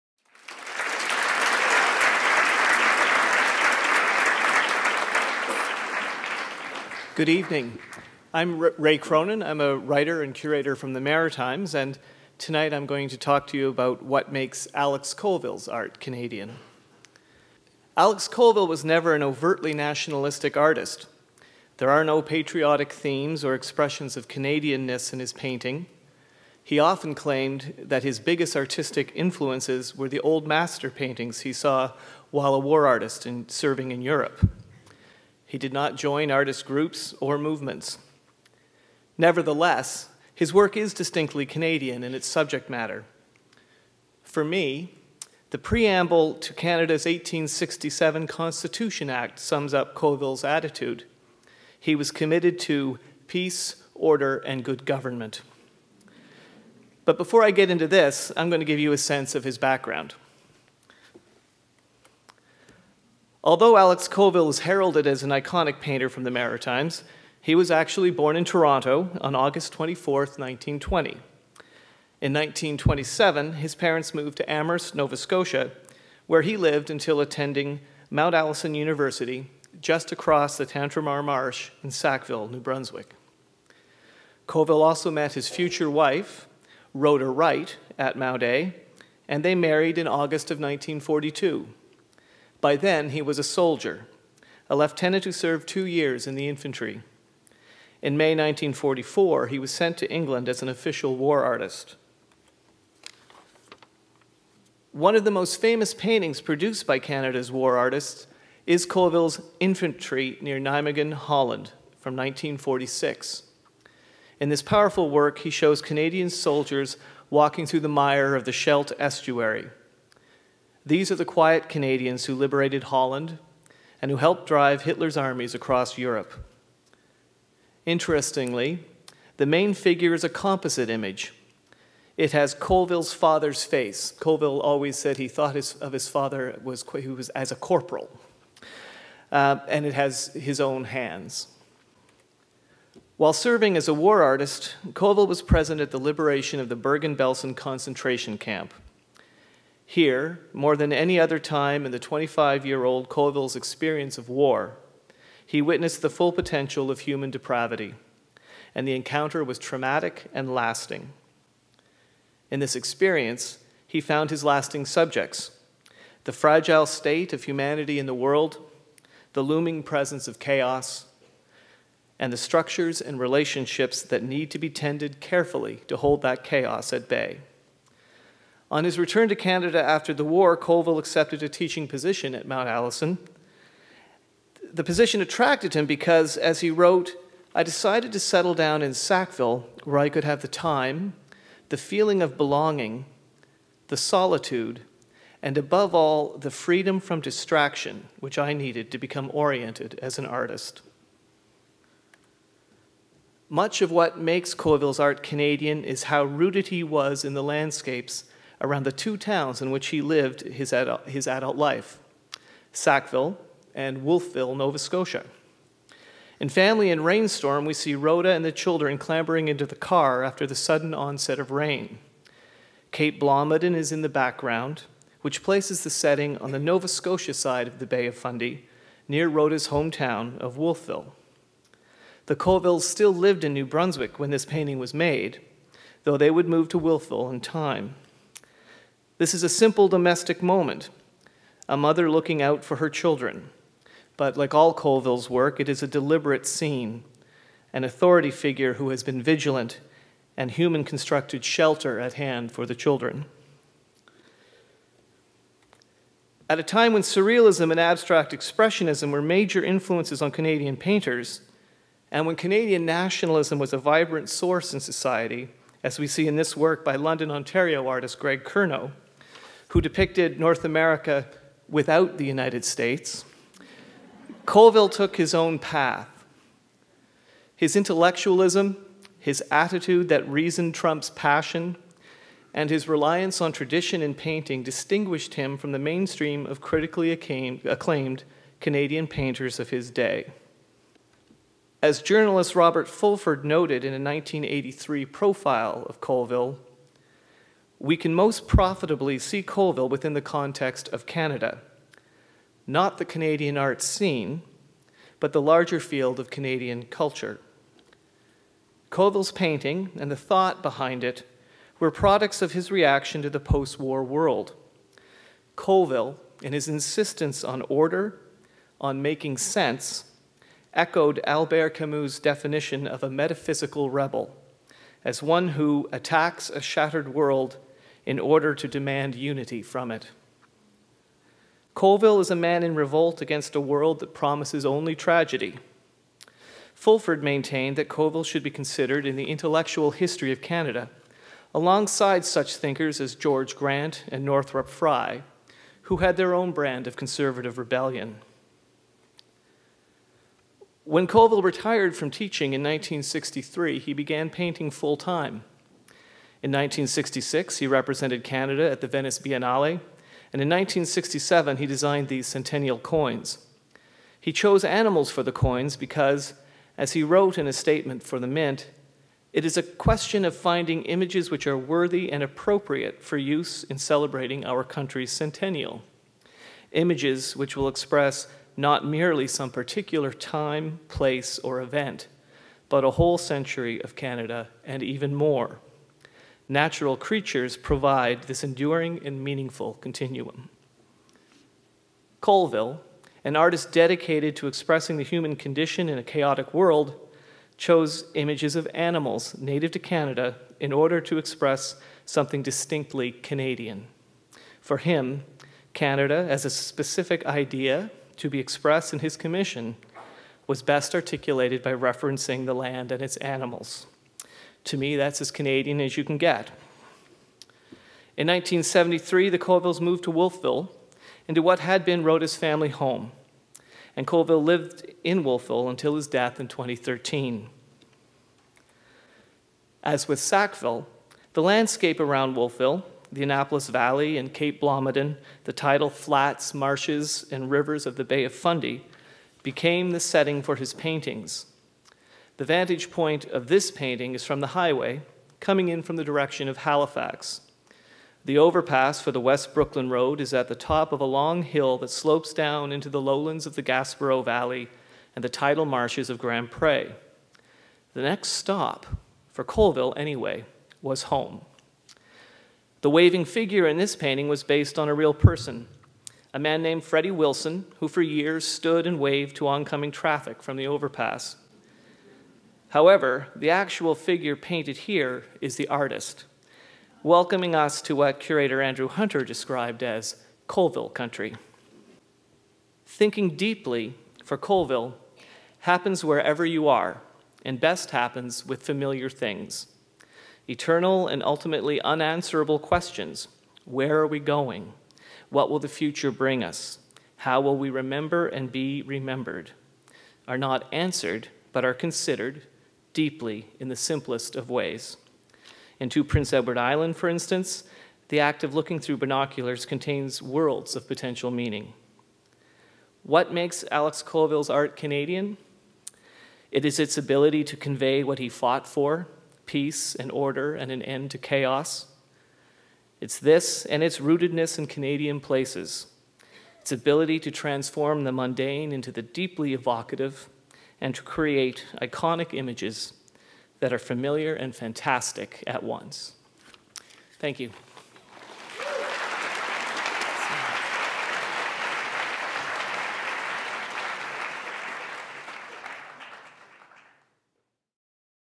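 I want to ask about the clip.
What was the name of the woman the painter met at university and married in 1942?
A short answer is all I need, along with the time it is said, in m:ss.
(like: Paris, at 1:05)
Rhoda Wright, at 1:26.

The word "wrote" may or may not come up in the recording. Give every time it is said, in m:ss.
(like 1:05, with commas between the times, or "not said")
3:06, 6:07.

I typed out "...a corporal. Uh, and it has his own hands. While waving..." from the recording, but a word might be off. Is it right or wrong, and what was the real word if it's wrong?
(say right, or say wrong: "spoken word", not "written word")
wrong: "serving", not "waving".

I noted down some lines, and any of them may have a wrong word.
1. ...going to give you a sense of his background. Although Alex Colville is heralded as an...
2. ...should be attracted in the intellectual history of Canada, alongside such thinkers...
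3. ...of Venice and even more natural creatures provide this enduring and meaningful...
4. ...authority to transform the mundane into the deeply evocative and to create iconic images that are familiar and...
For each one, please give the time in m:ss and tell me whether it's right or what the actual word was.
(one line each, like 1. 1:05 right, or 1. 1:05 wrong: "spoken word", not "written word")
1. 0:58 right
2. 5:38 wrong: "considered", not "attracted"
3. 6:23 wrong: "Canada", not "Venice"
4. 8:46 wrong: "ability", not "authority".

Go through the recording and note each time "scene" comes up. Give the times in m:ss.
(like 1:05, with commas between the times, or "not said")
4:06, 5:03.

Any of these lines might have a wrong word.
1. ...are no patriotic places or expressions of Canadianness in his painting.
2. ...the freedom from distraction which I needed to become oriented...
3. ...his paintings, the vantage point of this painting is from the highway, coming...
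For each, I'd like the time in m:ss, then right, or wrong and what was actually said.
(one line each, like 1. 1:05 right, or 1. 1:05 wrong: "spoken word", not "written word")
1. 0:21 wrong: "themes", not "places"
2. 3:16 right
3. 7:20 right.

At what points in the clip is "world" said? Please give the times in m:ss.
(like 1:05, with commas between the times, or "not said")
2:48, 5:14, 5:27, 5:33, 6:36, 8:30.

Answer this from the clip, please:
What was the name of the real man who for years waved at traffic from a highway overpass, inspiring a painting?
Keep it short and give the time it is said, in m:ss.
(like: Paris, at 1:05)
Freddie Wilson, at 7:46.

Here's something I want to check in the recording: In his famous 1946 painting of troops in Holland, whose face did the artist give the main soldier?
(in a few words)
His father's.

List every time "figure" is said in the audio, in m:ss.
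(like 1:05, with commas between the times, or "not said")
2:09, 4:08, 7:43, 7:53.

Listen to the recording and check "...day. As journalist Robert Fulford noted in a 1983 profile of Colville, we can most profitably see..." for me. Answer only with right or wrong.
right.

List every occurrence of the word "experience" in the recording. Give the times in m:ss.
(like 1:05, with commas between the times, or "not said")
2:33, 2:42.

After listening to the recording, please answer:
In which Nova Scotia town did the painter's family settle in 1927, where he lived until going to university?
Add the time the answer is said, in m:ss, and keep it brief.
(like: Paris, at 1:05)
Amherst, at 1:14.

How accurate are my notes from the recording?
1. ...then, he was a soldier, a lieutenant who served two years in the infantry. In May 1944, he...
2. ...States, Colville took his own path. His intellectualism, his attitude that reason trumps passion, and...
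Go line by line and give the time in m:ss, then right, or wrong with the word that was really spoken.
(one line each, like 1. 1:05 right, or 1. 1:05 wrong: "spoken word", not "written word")
1. 1:32 right
2. 4:32 right.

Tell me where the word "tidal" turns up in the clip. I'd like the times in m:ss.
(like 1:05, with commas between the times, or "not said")
7:15, 7:35.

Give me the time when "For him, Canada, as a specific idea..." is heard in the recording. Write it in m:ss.
6:44.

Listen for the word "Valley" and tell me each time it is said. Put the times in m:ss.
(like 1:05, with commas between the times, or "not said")
7:13, 7:34.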